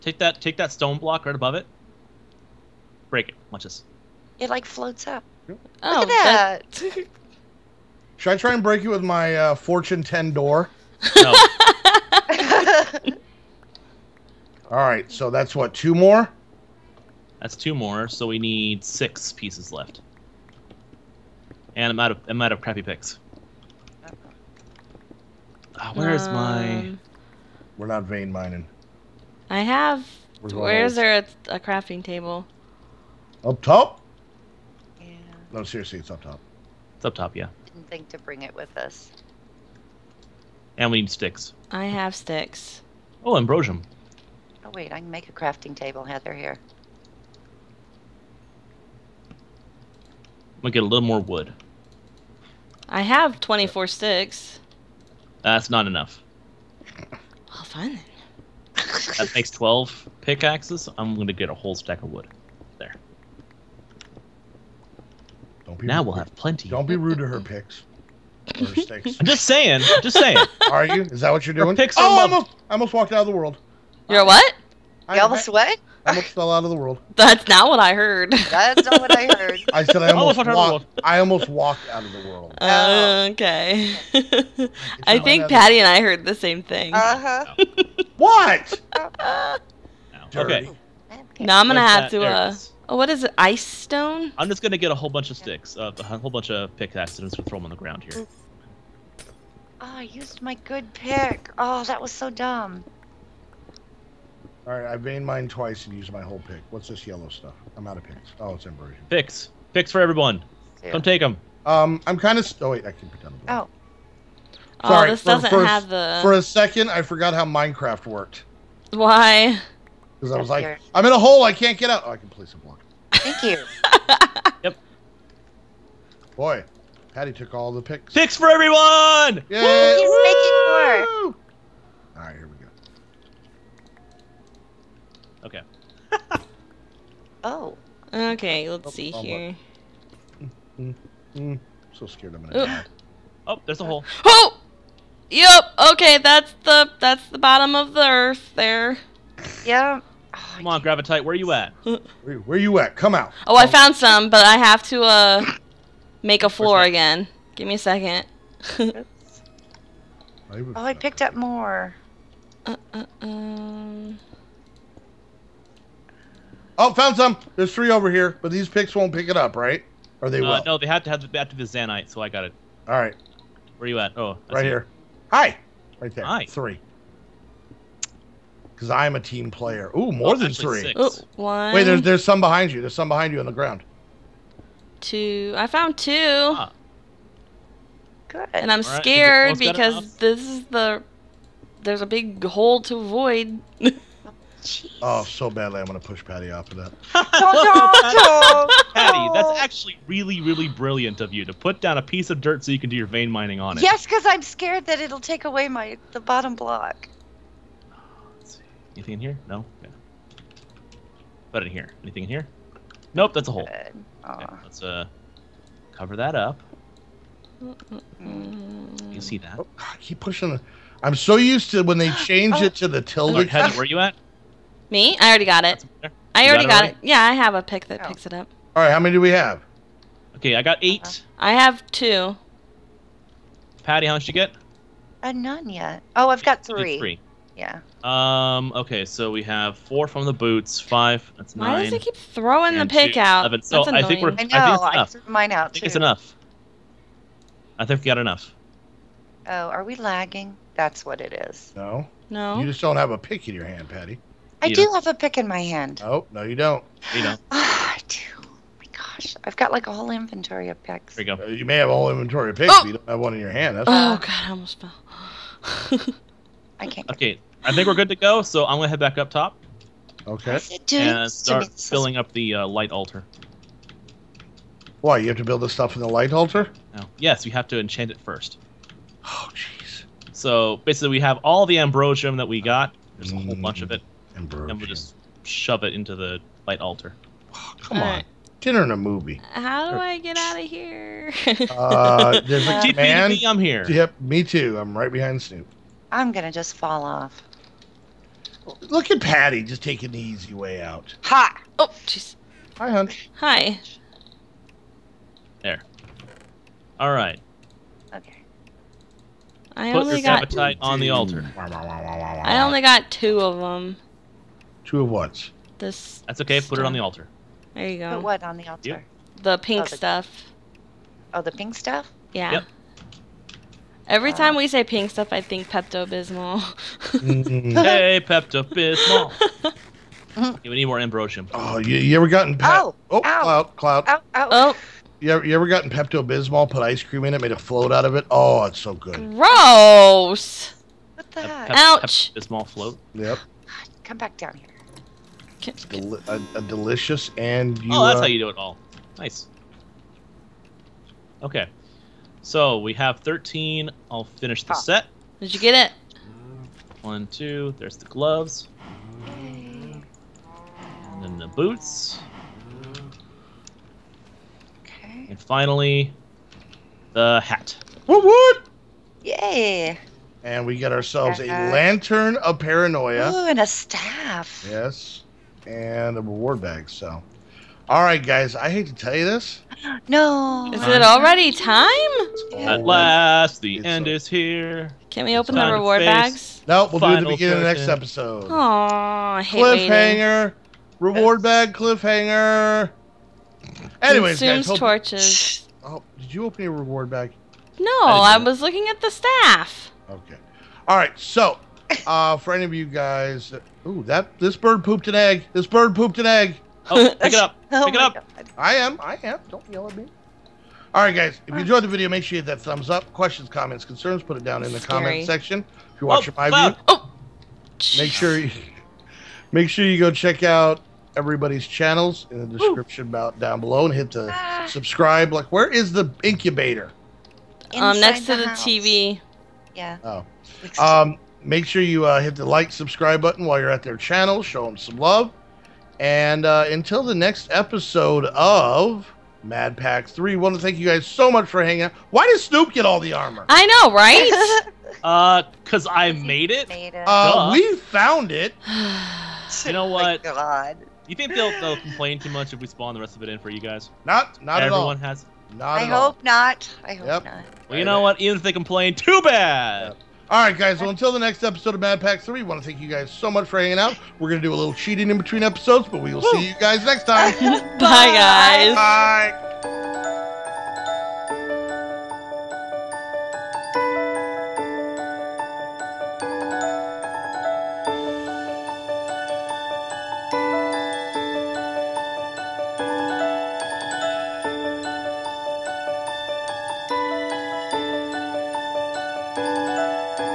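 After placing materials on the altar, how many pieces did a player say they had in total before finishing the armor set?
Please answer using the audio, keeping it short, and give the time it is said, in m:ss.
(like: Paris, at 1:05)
13, at 5:52.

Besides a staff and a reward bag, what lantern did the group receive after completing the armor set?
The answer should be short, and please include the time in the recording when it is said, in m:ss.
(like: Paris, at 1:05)
Lantern of paranoia, at 6:11.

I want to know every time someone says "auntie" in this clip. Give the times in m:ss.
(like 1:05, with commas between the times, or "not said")
not said.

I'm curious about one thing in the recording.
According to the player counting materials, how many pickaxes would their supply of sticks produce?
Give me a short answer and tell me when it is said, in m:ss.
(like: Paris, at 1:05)
12, at 0:58.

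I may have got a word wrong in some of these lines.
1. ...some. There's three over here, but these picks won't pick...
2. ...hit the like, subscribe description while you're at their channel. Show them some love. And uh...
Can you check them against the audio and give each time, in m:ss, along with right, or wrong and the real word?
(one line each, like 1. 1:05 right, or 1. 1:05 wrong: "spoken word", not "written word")
1. 2:47 right
2. 7:12 wrong: "button", not "description".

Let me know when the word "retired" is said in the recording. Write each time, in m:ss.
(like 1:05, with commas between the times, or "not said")
not said.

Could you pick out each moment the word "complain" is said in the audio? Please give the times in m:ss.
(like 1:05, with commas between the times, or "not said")
7:31, 7:38.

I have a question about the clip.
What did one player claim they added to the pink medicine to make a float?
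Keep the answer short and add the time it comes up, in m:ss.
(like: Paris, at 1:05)
Ice cream, at 5:36.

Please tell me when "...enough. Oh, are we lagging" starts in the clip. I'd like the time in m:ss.
4:08.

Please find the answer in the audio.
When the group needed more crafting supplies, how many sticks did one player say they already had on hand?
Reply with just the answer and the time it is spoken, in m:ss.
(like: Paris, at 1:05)
24, at 0:52.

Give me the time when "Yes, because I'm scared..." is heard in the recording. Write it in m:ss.
3:23.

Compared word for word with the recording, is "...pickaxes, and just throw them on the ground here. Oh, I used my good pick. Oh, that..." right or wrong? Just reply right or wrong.
right.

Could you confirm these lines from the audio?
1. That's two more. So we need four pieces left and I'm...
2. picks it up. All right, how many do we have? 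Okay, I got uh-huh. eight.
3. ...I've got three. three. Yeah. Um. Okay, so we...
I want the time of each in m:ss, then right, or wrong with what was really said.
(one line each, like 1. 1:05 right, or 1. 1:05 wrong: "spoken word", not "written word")
1. 0:17 wrong: "six", not "four"
2. 3:48 right
3. 3:56 right.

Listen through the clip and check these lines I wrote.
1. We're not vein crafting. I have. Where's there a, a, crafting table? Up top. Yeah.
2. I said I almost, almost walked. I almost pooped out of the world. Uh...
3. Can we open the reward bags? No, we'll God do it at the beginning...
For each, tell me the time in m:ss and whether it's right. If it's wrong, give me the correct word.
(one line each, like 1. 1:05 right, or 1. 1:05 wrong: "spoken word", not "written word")
1. 0:27 wrong: "mining", not "crafting"
2. 1:19 wrong: "walked", not "pooped"
3. 6:25 wrong: "Final", not "God".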